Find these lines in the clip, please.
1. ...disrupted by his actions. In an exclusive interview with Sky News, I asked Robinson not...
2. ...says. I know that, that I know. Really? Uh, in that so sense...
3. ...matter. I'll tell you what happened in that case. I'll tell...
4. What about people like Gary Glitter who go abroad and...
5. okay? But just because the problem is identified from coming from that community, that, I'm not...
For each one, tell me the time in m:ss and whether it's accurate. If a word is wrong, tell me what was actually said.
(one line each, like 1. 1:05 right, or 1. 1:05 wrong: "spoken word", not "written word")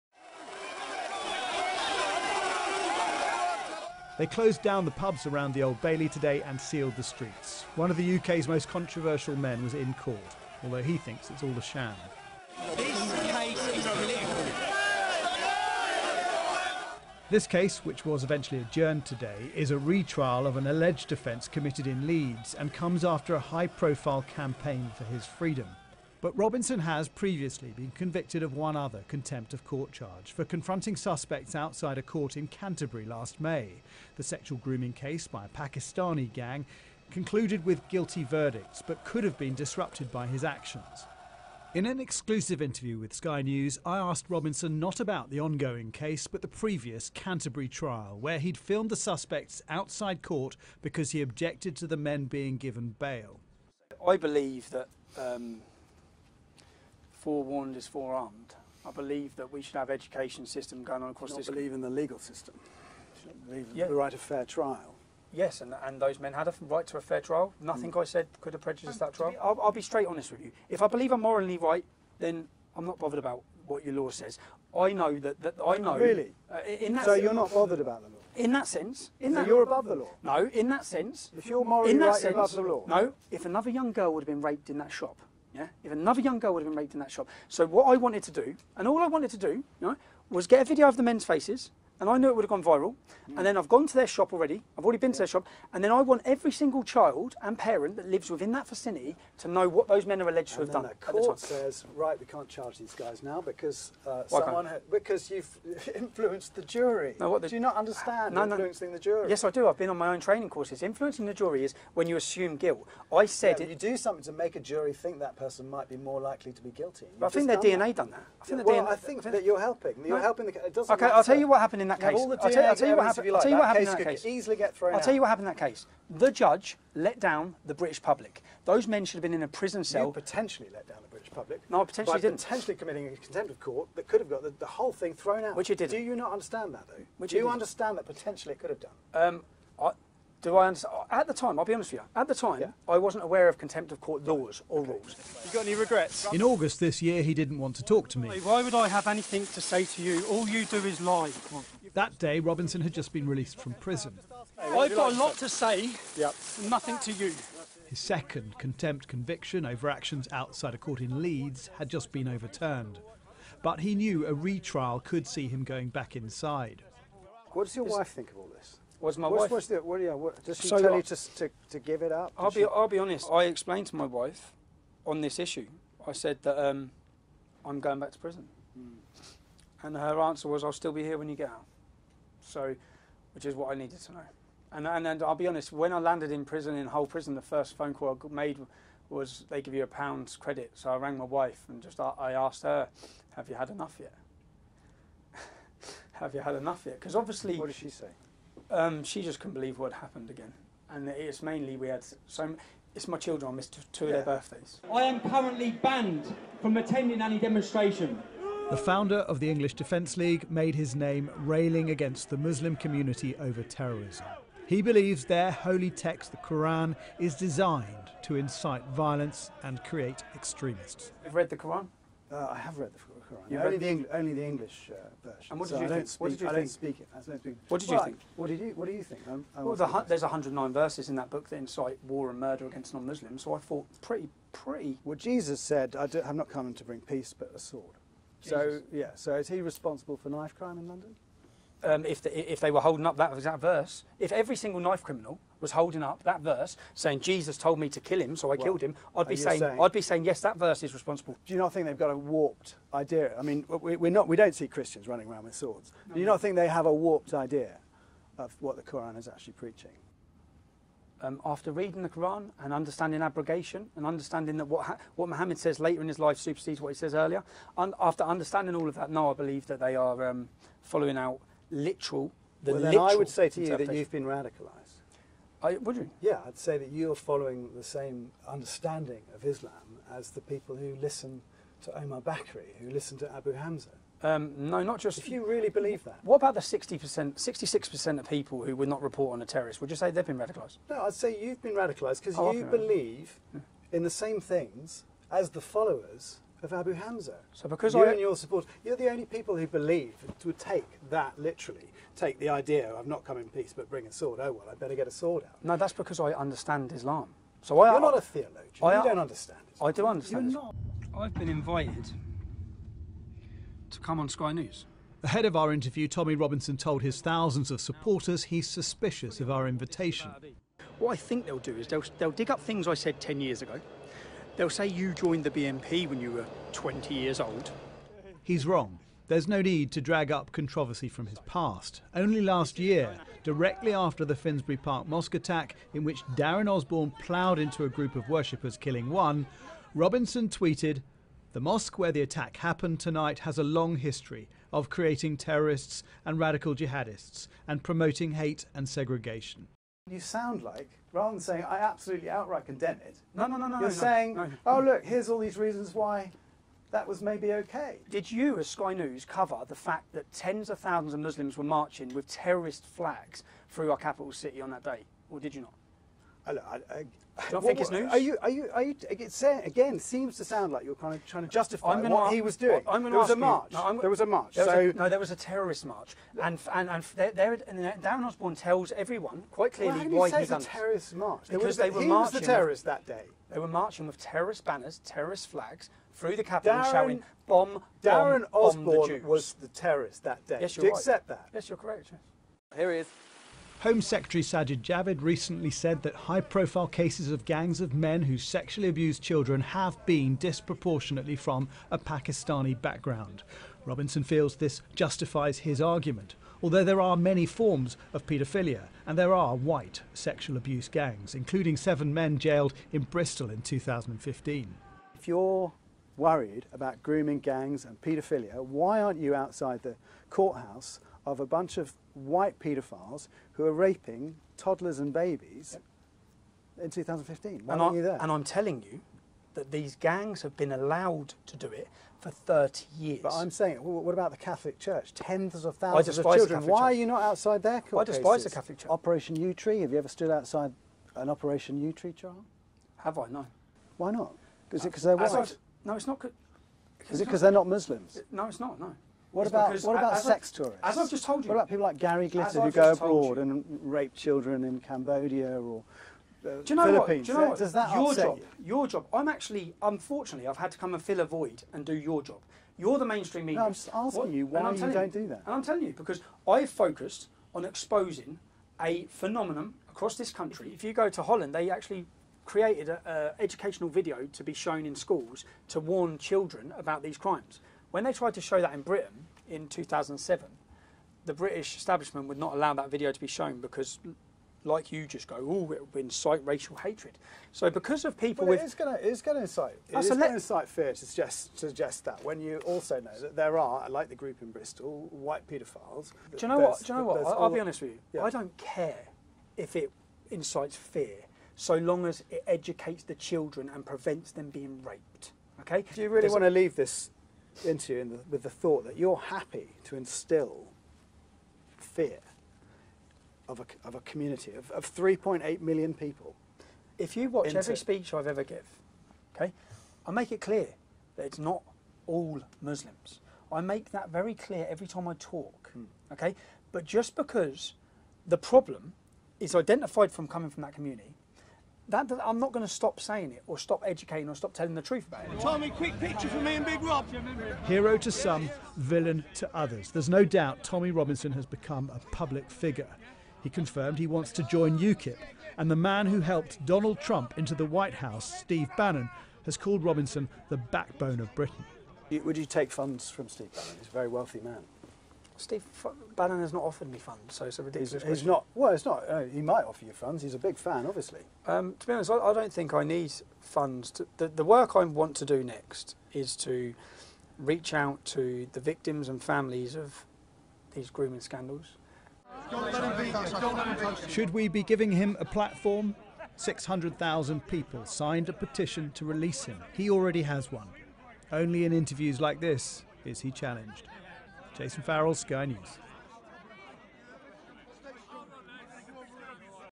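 1. 0:39 right
2. 1:14 right
3. 2:01 right
4. 7:31 right
5. 8:46 right.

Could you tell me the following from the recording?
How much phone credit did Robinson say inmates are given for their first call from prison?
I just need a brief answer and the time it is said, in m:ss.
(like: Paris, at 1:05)
£1, at 3:09.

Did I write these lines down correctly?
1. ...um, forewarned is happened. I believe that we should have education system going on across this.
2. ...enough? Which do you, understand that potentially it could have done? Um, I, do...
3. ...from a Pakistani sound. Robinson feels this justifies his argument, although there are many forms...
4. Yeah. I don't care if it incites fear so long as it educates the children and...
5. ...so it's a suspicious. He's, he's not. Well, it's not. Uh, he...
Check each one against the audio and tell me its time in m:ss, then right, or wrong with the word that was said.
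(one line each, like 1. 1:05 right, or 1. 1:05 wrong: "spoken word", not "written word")
1. 0:55 wrong: "forearmed", not "happened"
2. 2:16 wrong: "though", not "enough"
3. 6:41 wrong: "background", not "sound"
4. 8:18 right
5. 9:17 wrong: "ridiculous", not "suspicious".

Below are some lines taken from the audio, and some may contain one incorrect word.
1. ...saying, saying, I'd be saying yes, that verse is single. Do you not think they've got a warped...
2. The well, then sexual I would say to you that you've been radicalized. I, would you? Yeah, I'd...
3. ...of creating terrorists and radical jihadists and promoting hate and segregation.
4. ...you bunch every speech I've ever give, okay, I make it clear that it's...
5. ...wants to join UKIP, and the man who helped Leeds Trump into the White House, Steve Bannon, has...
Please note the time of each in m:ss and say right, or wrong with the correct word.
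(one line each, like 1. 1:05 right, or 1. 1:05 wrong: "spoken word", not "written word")
1. 4:09 wrong: "responsible", not "single"
2. 4:32 wrong: "literal", not "sexual"
3. 5:44 right
4. 8:37 wrong: "watch", not "bunch"
5. 9:04 wrong: "Donald", not "Leeds".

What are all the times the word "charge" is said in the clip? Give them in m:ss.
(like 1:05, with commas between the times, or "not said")
0:29, 1:42.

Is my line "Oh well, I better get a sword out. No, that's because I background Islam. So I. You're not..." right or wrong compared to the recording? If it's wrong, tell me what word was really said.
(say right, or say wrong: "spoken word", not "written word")
wrong: "understand", not "background".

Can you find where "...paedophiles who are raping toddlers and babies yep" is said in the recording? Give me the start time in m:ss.
7:02.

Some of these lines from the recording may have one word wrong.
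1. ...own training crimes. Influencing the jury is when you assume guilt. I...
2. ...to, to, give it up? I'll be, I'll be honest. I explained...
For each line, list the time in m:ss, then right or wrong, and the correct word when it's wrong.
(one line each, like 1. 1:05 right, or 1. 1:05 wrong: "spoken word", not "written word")
1. 1:50 wrong: "courses", not "crimes"
2. 2:51 right.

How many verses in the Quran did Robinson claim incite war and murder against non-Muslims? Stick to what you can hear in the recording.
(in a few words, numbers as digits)
109.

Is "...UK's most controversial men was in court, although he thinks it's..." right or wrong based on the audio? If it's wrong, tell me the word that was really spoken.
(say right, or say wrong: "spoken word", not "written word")
right.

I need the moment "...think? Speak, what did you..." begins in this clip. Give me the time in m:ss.
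3:45.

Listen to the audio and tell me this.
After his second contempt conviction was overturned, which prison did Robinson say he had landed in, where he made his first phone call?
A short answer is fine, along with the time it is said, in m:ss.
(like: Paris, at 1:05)
Hull, at 3:06.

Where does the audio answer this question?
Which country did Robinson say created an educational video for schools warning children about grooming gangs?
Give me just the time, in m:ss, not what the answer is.
7:51.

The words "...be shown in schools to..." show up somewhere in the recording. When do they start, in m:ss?
7:54.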